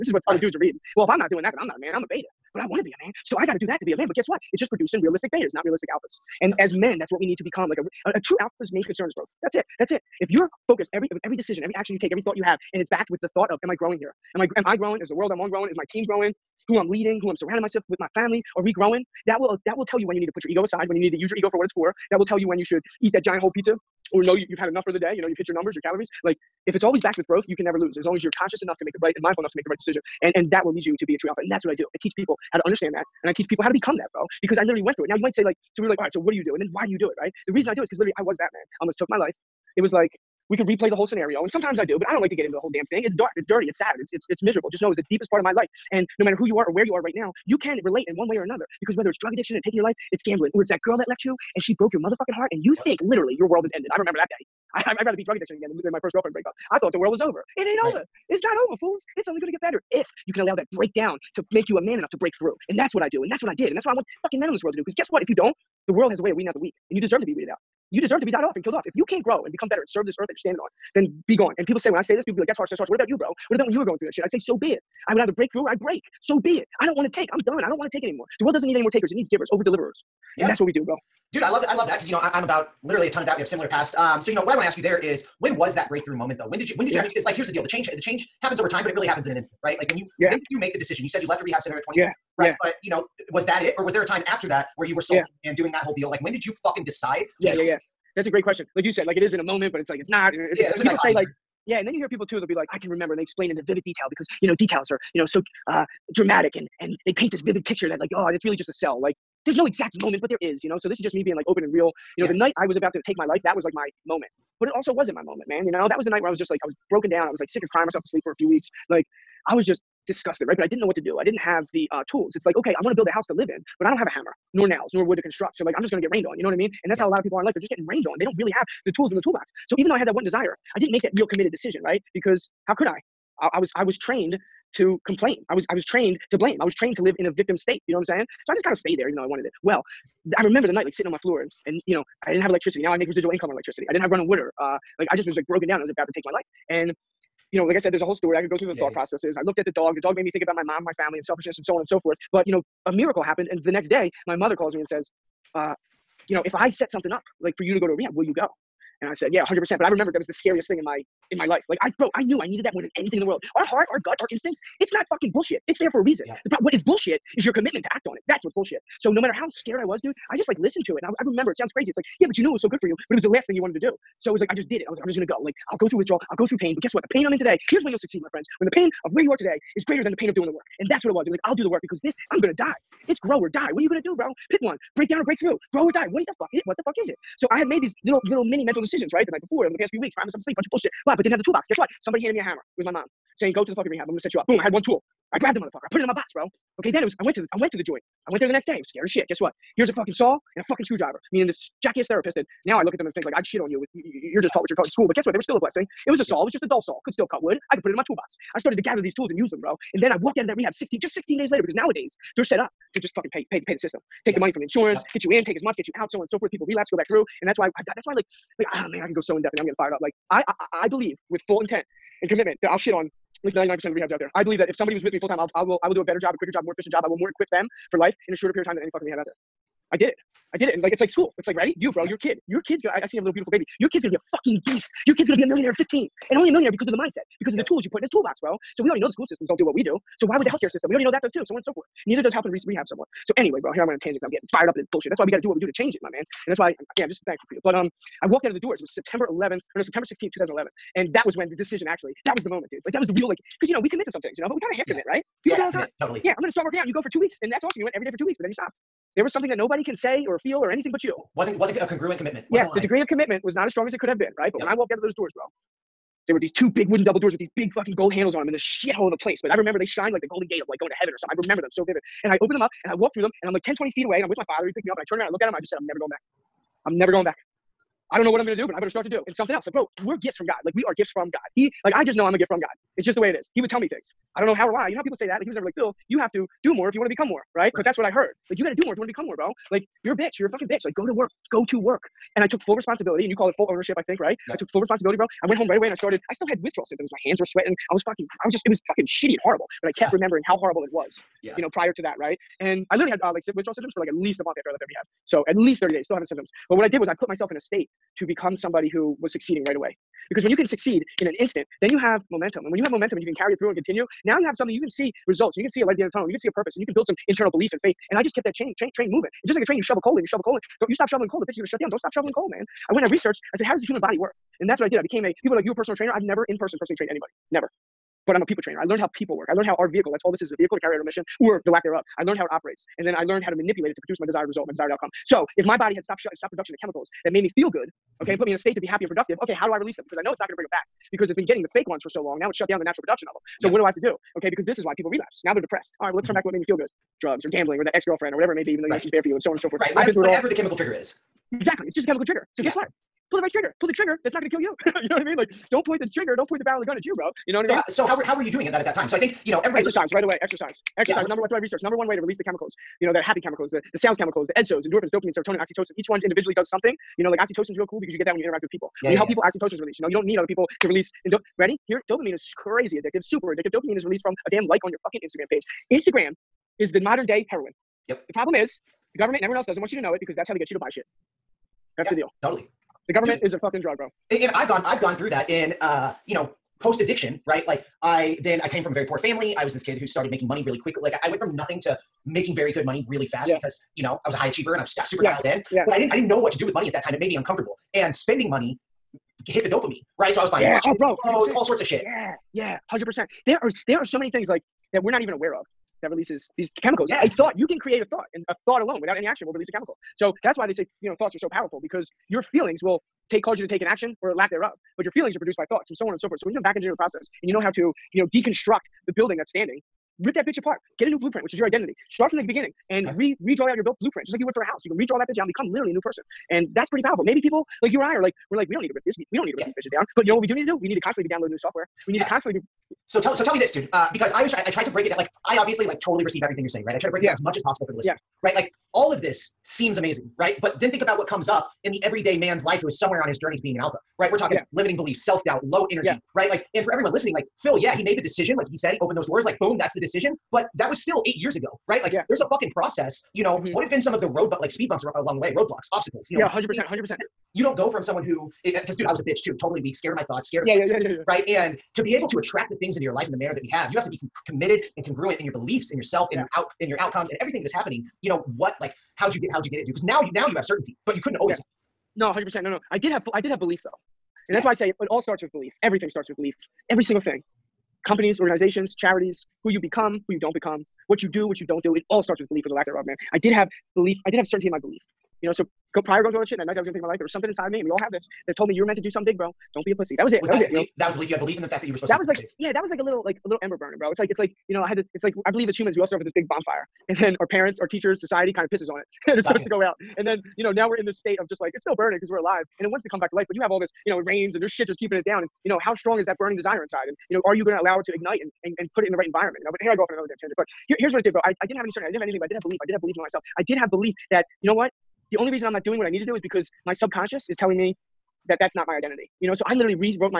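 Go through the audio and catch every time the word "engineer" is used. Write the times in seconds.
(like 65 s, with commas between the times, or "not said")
416 s.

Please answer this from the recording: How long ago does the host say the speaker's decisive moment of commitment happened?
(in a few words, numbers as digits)
8 years.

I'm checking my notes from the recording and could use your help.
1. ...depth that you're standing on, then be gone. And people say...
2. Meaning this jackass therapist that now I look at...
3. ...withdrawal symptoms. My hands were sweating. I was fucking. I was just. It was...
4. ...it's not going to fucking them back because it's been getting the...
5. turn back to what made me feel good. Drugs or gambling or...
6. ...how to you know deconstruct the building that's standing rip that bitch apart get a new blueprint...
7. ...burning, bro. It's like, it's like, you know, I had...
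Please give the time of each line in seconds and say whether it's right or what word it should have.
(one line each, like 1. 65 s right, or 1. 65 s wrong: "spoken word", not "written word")
1. 70 s wrong: "earth", not "depth"
2. 201 s right
3. 296 s right
4. 340 s wrong: "bring", not "fucking"
5. 346 s right
6. 417 s right
7. 493 s right.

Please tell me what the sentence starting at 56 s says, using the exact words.
I thought the world was over.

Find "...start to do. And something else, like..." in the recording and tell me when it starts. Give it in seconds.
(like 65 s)
278 s.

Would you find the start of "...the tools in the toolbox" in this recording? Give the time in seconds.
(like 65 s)
128 s.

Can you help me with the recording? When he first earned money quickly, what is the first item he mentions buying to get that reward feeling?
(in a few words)
watches.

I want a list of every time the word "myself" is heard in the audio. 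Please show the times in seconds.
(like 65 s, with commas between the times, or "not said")
17 s, 117 s, 190 s, 307 s, 513 s.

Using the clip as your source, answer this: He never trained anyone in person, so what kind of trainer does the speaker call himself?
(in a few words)
people trainer.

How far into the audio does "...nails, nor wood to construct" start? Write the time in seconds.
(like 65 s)
124 s.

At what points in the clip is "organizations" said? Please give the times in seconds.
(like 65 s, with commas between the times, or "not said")
478 s.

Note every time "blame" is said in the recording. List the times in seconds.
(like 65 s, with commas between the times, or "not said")
136 s.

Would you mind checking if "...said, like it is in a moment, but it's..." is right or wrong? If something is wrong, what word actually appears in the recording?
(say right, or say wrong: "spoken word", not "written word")
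right.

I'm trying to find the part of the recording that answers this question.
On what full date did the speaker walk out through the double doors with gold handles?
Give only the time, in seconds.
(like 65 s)
249 s.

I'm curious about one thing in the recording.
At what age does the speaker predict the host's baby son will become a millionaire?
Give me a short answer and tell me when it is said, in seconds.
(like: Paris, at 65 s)
15, at 235 s.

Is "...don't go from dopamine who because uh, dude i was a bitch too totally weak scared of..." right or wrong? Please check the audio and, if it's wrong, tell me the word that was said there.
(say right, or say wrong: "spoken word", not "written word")
wrong: "someone", not "dopamine".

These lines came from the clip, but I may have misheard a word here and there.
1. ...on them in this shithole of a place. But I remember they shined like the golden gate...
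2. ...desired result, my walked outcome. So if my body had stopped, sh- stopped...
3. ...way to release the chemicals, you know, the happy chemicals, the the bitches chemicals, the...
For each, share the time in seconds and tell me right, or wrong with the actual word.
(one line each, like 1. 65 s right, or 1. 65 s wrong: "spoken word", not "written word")
1. 268 s right
2. 334 s wrong: "desired", not "walked"
3. 362 s wrong: "sales", not "bitches".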